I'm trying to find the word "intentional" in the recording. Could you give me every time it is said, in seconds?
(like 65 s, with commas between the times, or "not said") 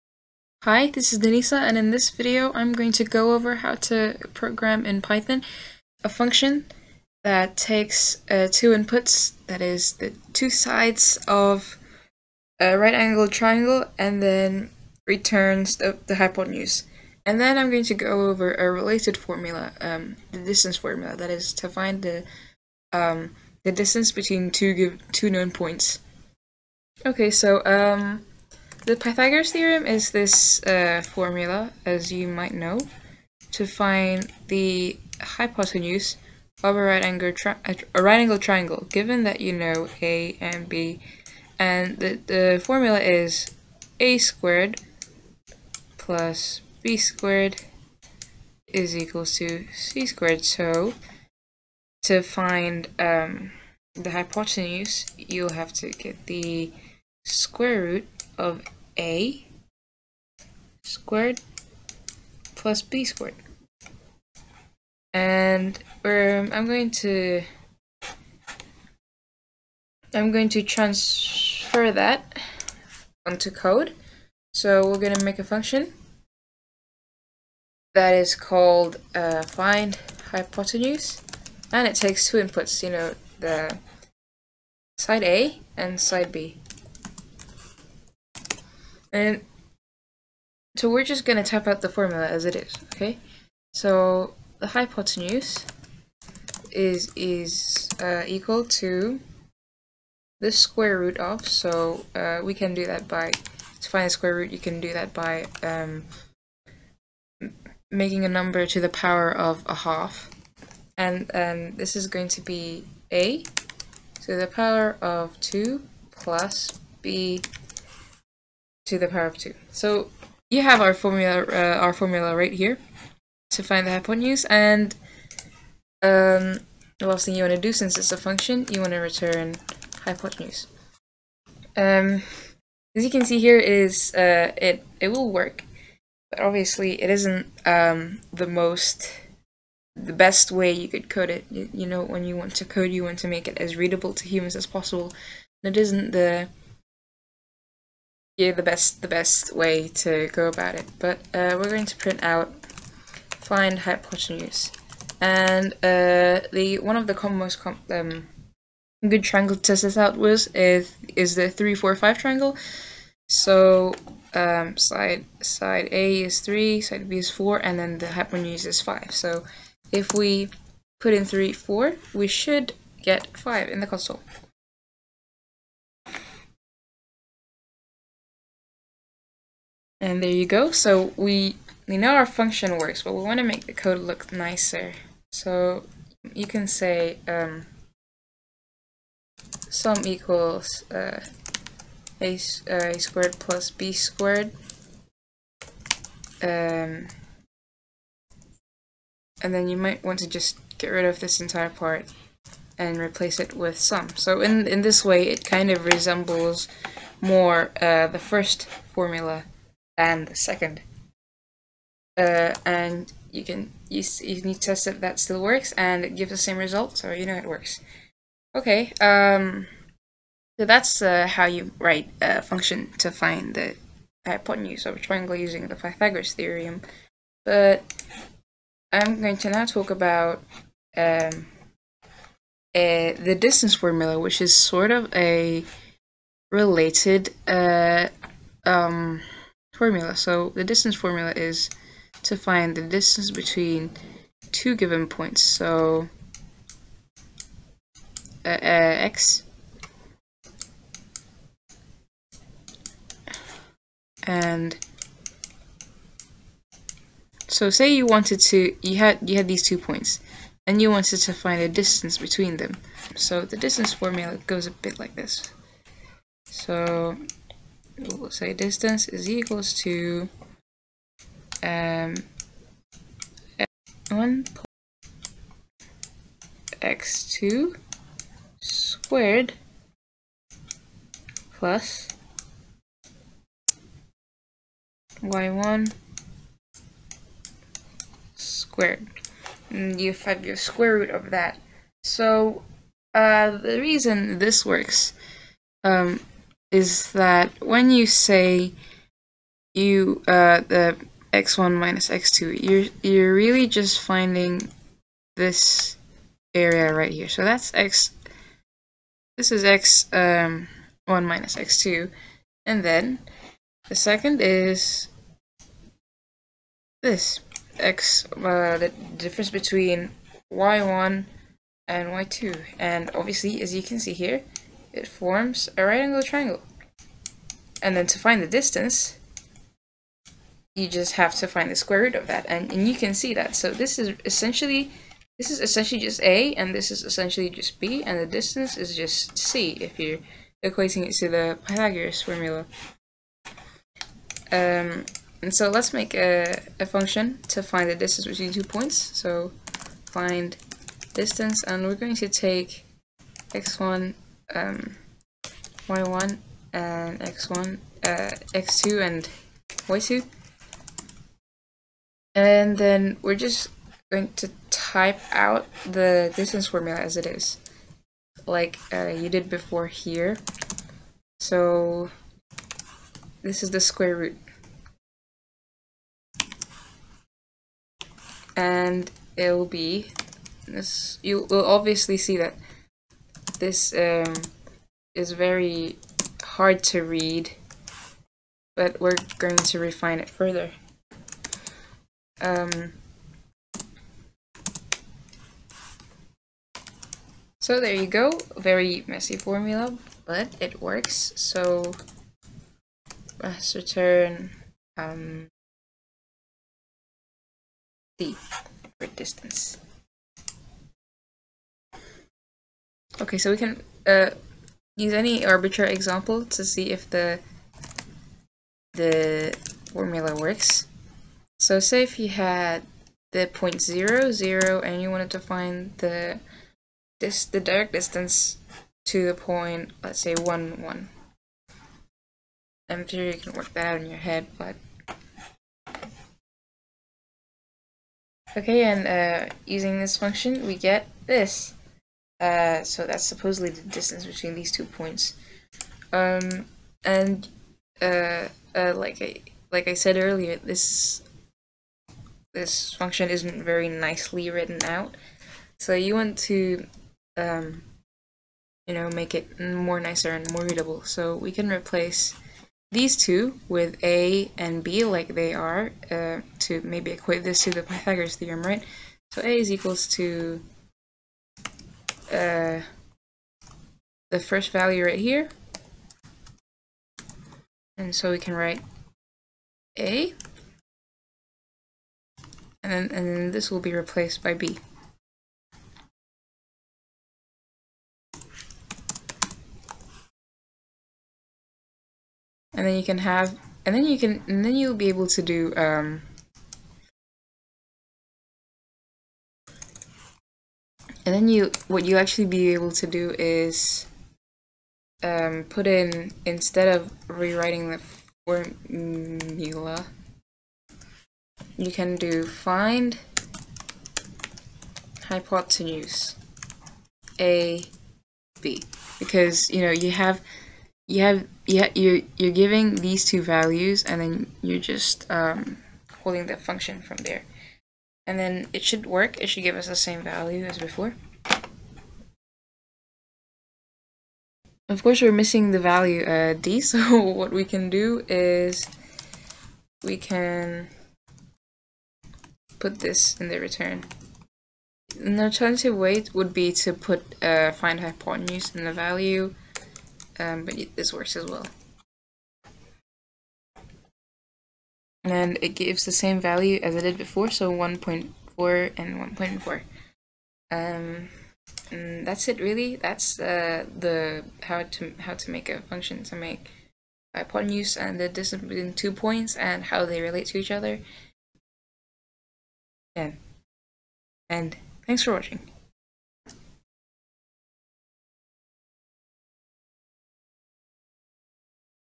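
not said.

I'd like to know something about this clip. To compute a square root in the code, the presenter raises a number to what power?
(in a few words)
a half.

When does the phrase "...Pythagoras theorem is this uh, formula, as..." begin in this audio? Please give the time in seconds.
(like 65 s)
28 s.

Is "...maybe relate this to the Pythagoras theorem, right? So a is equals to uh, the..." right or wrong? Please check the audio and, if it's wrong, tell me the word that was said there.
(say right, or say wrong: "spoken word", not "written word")
wrong: "equate", not "relate".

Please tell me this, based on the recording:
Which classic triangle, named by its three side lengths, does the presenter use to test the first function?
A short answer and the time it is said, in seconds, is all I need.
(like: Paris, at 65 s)
three four five triangle, at 161 s.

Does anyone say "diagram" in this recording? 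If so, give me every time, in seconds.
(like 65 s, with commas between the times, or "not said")
not said.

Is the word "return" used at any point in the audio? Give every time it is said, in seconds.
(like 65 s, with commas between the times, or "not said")
15 s, 128 s, 403 s, 543 s.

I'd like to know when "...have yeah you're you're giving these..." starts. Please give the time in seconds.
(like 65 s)
521 s.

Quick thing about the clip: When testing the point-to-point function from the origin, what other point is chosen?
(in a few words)
1, 1.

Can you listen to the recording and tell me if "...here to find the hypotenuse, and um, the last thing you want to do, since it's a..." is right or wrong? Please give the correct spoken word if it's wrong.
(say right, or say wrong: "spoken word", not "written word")
right.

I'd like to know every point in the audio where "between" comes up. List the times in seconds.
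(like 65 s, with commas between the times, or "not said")
24 s, 243 s, 262 s, 319 s, 348 s, 444 s, 568 s.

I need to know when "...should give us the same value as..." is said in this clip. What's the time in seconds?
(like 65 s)
529 s.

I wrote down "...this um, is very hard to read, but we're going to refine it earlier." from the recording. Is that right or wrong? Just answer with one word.
wrong.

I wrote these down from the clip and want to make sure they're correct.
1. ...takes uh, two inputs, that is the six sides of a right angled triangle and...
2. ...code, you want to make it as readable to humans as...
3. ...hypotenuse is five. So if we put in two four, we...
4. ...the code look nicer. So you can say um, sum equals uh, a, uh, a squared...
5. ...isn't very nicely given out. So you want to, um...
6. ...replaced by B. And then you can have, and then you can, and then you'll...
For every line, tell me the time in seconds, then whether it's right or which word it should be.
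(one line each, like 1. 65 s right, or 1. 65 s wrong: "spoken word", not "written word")
1. 7 s wrong: "two", not "six"
2. 142 s right
3. 168 s wrong: "three", not "two"
4. 183 s right
5. 453 s wrong: "written", not "given"
6. 483 s right.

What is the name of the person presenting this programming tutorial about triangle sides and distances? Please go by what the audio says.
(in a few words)
Denisa.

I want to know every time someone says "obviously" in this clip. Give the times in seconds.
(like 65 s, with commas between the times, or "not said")
136 s, 323 s, 381 s.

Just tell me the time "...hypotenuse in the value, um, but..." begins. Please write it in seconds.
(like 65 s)
547 s.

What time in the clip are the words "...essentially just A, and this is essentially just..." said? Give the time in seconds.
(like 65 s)
335 s.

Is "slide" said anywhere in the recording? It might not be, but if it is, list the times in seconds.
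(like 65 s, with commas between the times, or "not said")
not said.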